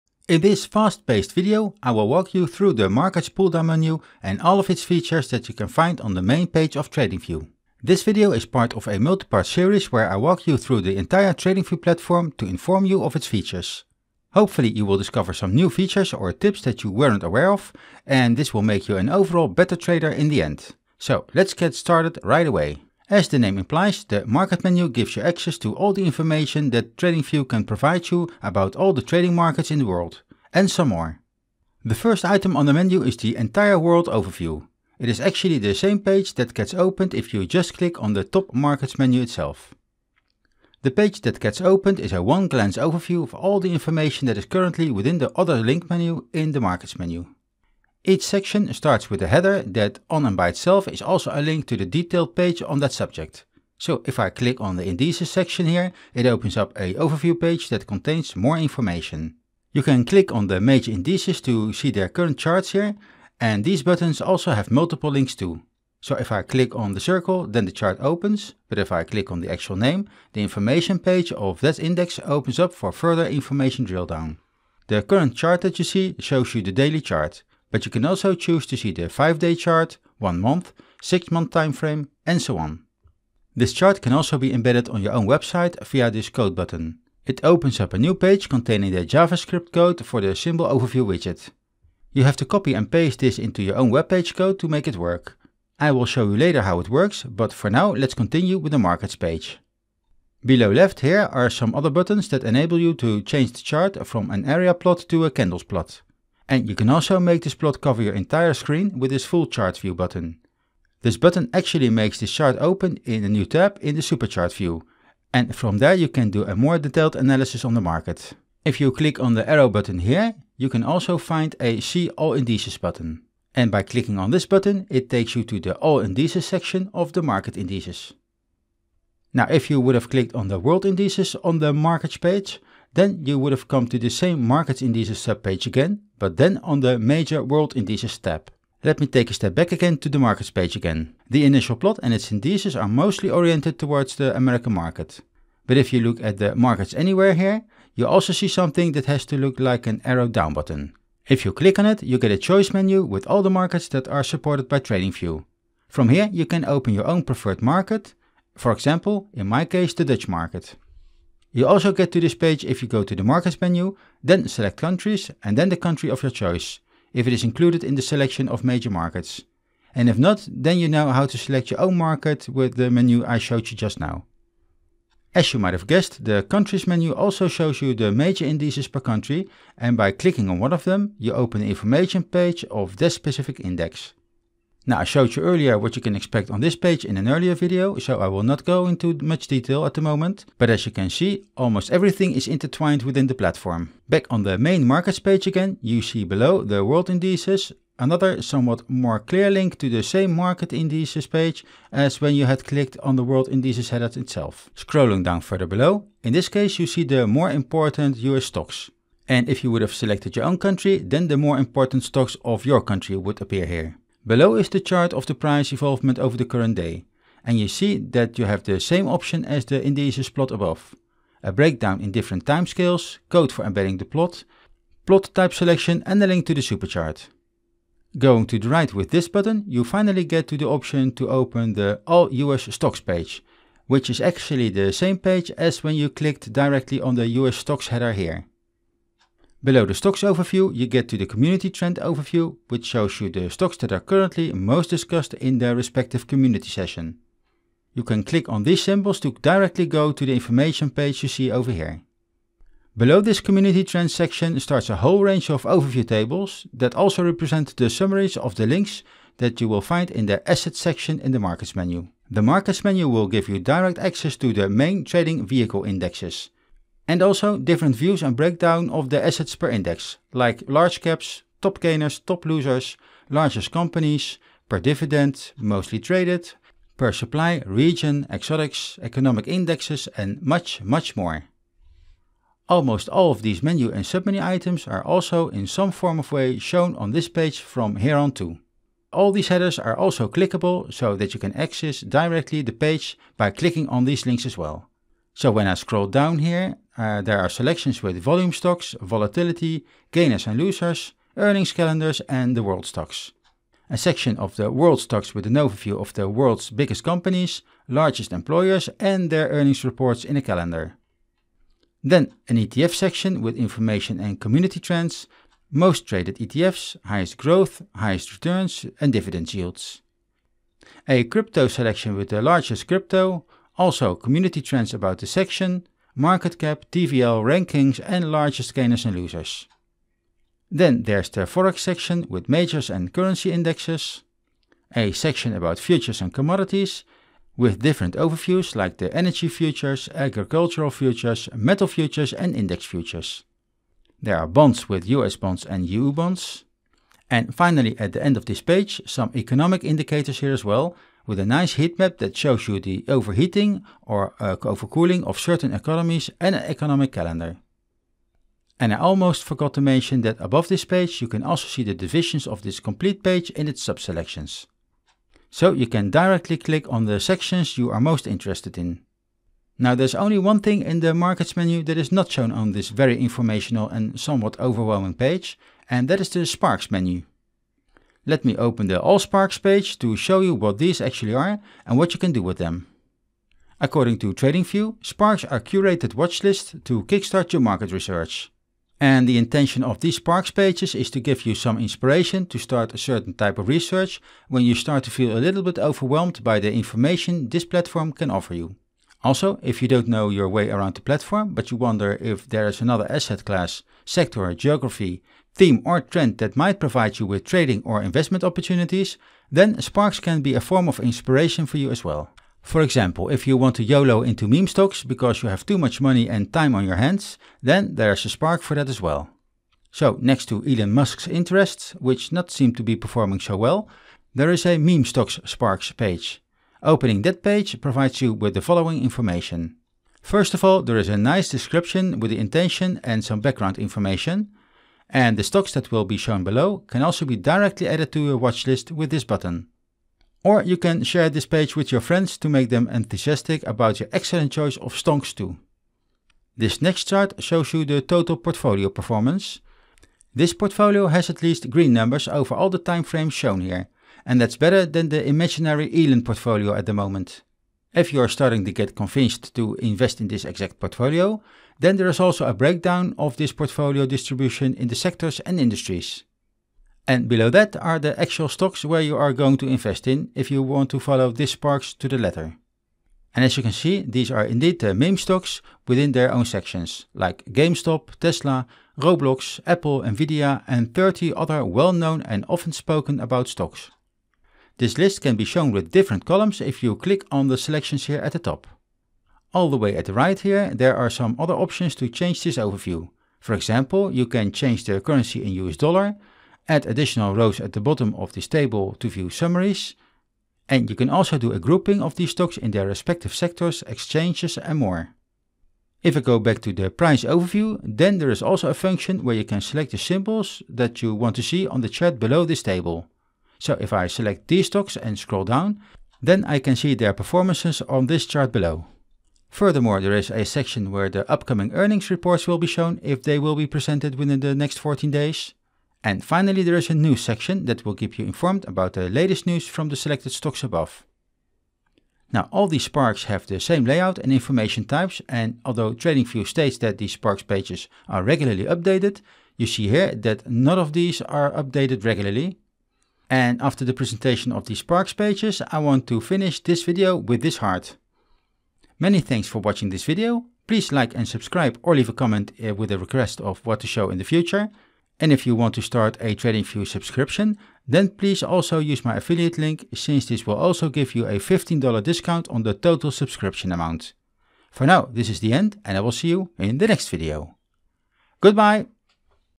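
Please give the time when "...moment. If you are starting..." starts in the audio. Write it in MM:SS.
07:36.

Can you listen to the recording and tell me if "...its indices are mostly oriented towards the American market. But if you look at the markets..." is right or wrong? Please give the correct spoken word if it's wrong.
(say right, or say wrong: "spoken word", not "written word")
right.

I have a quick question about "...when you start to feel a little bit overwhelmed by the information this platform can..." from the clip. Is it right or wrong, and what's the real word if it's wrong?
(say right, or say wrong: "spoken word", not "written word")
right.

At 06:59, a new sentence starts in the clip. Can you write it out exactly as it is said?
So next to Elon Musk's interests, which not seem to be performing so well, there is a meme stocks sparks page.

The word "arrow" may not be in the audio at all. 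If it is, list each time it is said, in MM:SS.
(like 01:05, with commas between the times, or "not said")
01:59, 02:30.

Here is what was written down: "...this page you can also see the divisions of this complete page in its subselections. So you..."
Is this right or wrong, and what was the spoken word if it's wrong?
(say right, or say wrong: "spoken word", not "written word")
right.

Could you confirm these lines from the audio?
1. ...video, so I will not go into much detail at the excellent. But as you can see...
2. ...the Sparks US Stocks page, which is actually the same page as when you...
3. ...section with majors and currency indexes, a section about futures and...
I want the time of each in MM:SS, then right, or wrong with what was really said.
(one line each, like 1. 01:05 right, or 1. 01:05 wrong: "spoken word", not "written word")
1. 03:07 wrong: "moment", not "excellent"
2. 03:51 wrong: "All", not "Sparks"
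3. 05:31 right.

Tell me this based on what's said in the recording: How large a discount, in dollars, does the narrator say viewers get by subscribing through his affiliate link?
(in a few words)
$15.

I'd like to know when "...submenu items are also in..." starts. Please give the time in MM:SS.
04:44.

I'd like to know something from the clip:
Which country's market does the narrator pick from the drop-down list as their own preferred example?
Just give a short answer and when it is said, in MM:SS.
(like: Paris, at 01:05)
Dutch, at 02:39.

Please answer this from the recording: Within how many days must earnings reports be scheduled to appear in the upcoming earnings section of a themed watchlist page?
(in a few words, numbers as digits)
14.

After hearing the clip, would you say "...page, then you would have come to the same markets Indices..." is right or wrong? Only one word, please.
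right.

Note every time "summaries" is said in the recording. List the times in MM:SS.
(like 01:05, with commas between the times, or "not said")
04:17, 08:19.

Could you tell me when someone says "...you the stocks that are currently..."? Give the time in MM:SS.
04:03.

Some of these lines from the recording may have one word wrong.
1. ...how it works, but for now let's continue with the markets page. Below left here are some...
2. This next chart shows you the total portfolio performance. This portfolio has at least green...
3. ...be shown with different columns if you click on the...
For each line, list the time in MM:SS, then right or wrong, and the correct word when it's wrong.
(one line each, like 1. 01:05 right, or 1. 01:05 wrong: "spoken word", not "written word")
1. 01:36 right
2. 07:26 right
3. 08:05 right.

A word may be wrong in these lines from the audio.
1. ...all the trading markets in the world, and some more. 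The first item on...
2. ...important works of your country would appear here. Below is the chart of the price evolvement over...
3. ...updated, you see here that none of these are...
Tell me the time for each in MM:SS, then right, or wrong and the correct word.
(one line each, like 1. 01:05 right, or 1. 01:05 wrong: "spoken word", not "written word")
1. 00:28 right
2. 03:31 wrong: "stocks", not "works"
3. 08:58 right.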